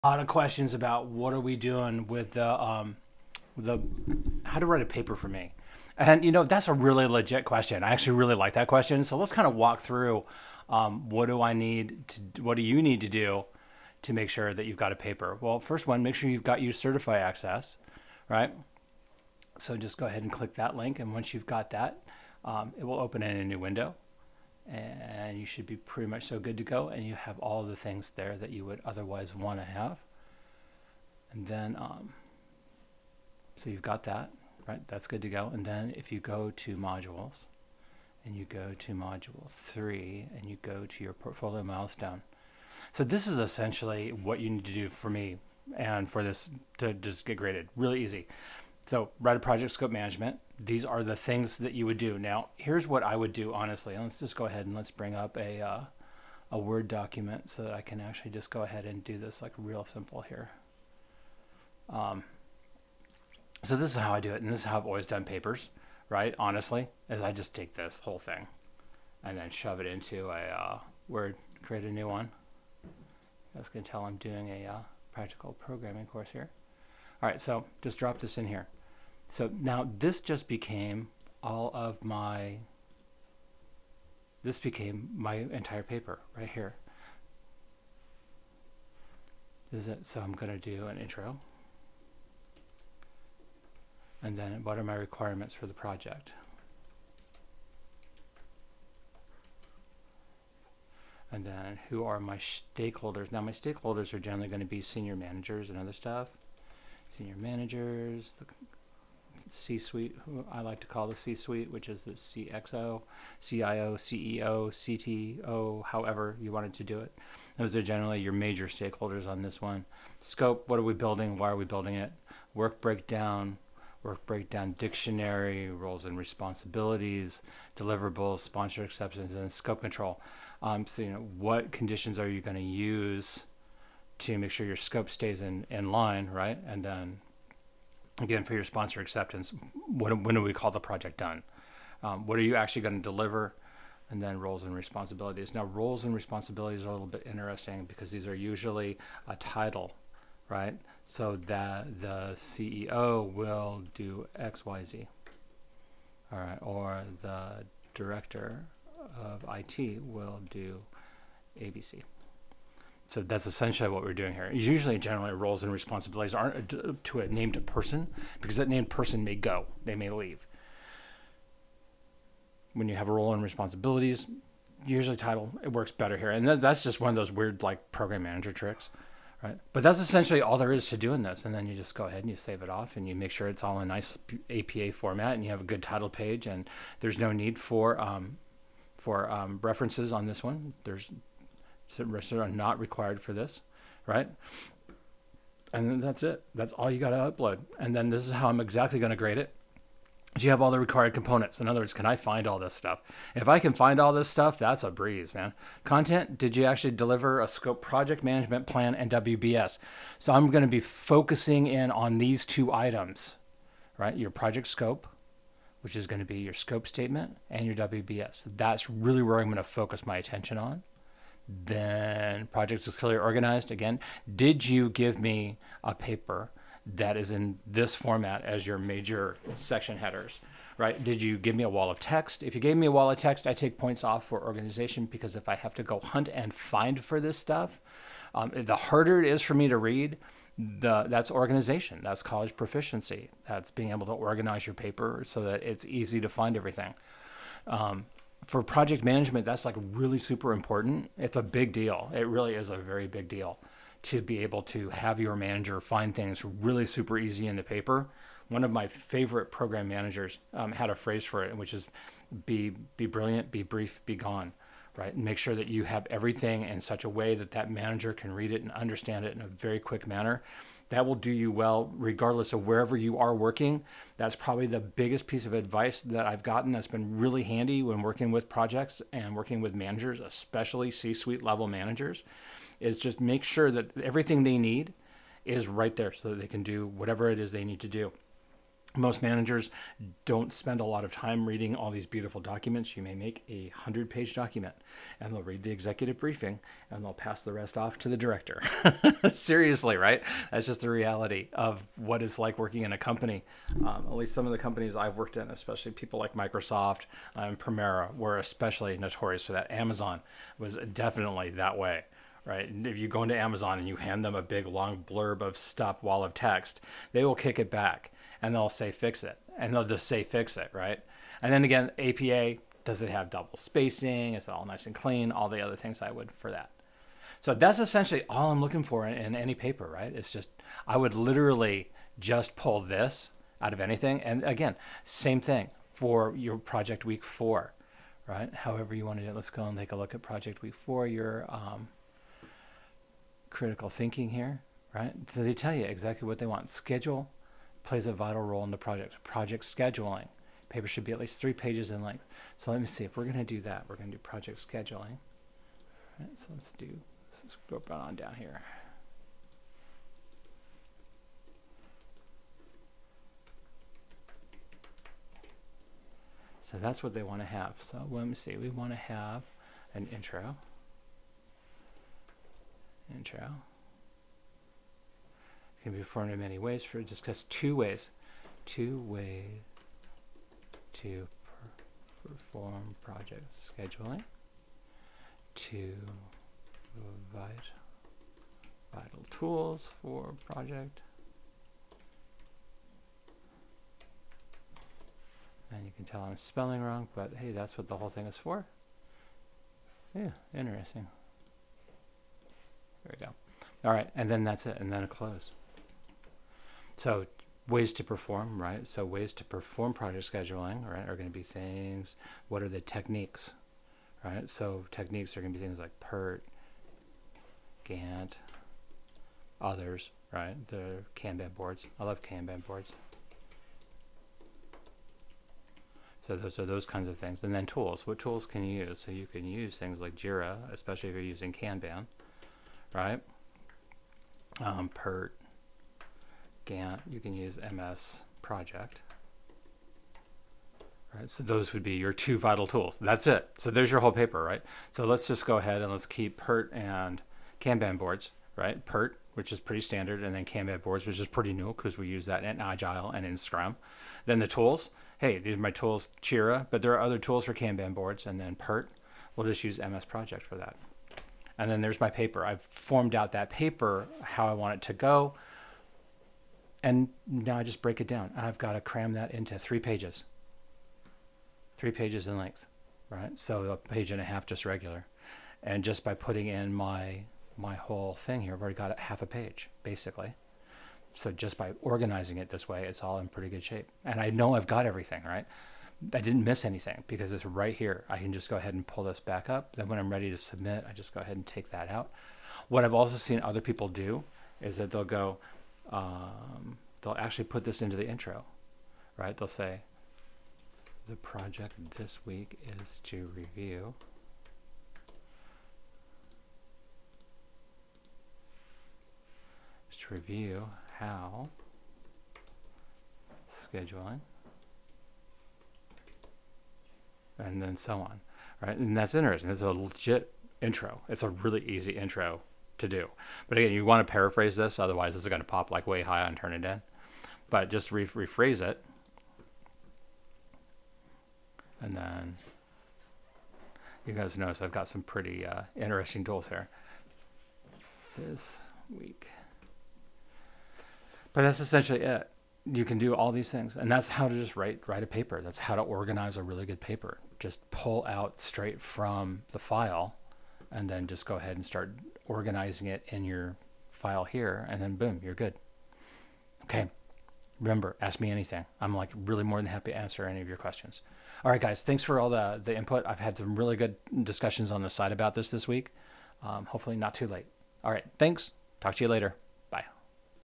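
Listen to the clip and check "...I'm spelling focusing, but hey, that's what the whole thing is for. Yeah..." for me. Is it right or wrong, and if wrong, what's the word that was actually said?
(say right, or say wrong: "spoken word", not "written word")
wrong: "wrong", not "focusing".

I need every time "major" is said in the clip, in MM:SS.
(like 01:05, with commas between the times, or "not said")
01:58, 03:48.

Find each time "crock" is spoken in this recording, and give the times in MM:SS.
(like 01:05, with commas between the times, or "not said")
not said.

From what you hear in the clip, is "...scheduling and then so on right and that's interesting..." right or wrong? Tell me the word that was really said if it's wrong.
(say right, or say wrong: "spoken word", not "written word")
right.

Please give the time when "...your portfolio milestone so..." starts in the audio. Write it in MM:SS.
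00:41.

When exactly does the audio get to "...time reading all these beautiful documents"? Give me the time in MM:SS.
04:51.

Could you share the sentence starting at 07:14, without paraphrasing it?
Um, PERT, Gantt, you can use MS project.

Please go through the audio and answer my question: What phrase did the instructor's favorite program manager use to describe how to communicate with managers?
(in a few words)
Be brilliant, be brief, be gone.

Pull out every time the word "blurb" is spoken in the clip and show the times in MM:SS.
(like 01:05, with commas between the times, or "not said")
05:15.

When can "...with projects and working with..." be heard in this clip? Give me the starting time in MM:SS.
04:38.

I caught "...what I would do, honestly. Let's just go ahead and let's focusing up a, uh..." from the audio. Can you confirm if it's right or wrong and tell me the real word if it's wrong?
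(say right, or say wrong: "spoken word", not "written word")
wrong: "bring", not "focusing".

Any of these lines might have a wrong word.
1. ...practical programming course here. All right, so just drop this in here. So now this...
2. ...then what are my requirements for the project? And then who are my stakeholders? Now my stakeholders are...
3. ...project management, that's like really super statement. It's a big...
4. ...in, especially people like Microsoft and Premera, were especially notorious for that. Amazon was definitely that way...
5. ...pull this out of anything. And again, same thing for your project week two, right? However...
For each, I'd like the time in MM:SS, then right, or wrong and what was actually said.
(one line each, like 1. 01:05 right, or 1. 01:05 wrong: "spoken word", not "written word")
1. 01:15 right
2. 01:34 right
3. 04:08 wrong: "important", not "statement"
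4. 05:05 right
5. 05:32 wrong: "four", not "two".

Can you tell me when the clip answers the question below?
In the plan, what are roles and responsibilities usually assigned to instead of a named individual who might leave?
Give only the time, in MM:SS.
02:29.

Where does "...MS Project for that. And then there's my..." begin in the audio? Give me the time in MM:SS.
07:39.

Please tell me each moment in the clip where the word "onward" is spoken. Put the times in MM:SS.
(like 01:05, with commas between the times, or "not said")
not said.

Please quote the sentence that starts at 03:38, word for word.
That's really where I'm going to focus my attention on.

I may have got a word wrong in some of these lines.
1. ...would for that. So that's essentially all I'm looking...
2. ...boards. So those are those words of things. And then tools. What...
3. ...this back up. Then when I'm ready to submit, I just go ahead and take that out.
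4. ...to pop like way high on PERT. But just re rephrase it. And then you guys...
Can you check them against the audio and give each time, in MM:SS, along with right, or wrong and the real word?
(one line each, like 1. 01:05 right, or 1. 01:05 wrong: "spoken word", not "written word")
1. 05:26 right
2. 07:02 wrong: "kinds", not "words"
3. 08:09 right
4. 08:45 wrong: "Turnitin", not "PERT".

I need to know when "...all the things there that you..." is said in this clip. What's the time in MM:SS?
00:27.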